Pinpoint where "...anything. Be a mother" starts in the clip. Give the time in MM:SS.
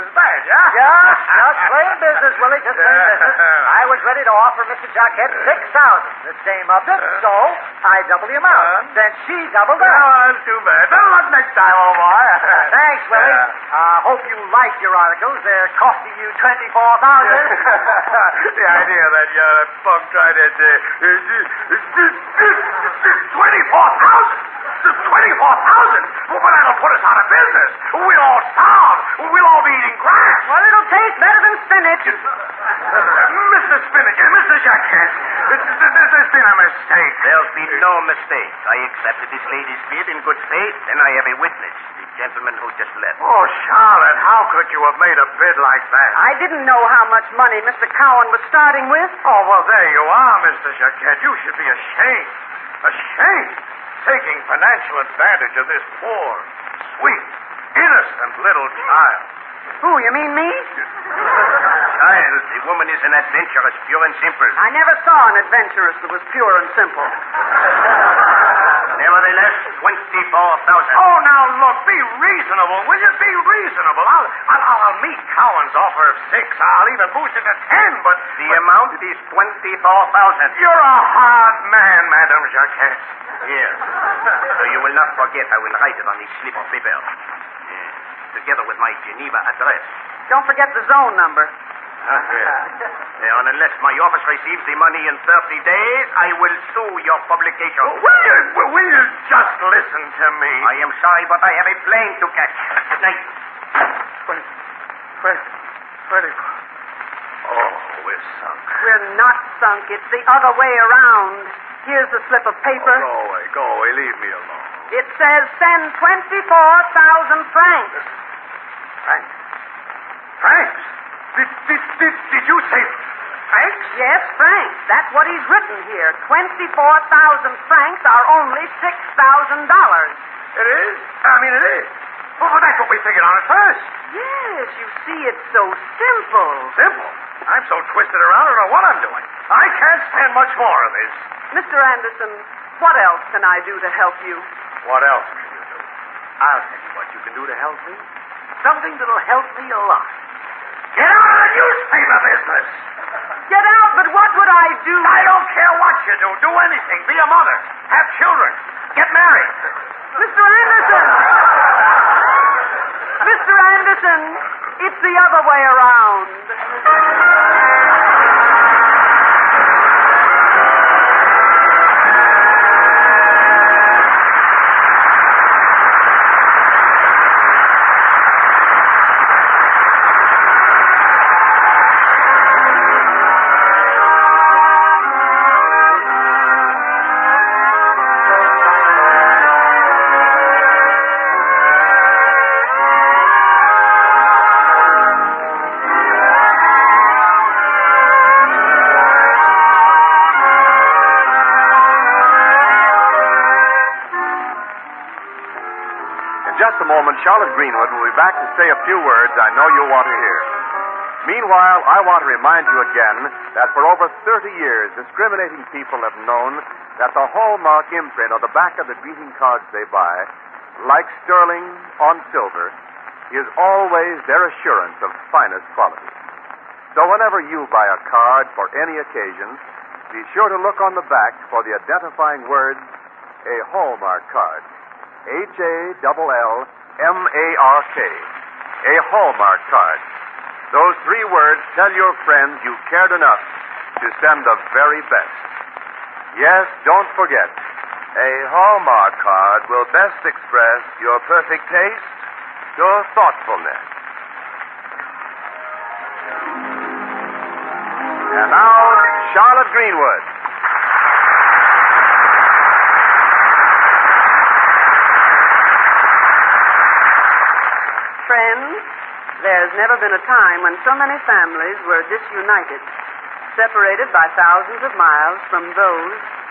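02:36.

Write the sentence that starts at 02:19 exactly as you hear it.
I can't stand much more of this.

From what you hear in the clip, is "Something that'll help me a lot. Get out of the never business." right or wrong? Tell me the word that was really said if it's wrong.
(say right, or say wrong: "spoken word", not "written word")
wrong: "newspaper", not "never".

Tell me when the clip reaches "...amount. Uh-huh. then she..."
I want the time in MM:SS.
00:08.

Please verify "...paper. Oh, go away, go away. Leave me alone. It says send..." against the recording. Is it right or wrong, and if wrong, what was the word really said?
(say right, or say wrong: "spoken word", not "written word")
right.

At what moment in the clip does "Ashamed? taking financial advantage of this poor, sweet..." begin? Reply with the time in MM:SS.
00:52.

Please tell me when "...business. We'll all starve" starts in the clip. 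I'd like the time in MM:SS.
00:27.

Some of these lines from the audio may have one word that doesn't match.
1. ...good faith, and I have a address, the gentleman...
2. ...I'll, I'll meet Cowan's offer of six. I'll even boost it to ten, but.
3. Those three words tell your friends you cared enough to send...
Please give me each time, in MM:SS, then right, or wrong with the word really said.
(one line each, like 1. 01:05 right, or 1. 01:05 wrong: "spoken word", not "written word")
1. 00:40 wrong: "witness", not "address"
2. 01:14 right
3. 04:00 right.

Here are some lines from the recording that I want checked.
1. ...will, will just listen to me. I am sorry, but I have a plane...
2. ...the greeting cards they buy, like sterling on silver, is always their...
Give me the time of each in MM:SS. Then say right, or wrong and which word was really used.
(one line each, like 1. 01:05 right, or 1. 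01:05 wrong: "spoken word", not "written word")
1. 01:38 right
2. 03:38 right.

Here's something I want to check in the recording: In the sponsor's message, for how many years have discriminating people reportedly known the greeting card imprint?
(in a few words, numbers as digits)
Over 30 years.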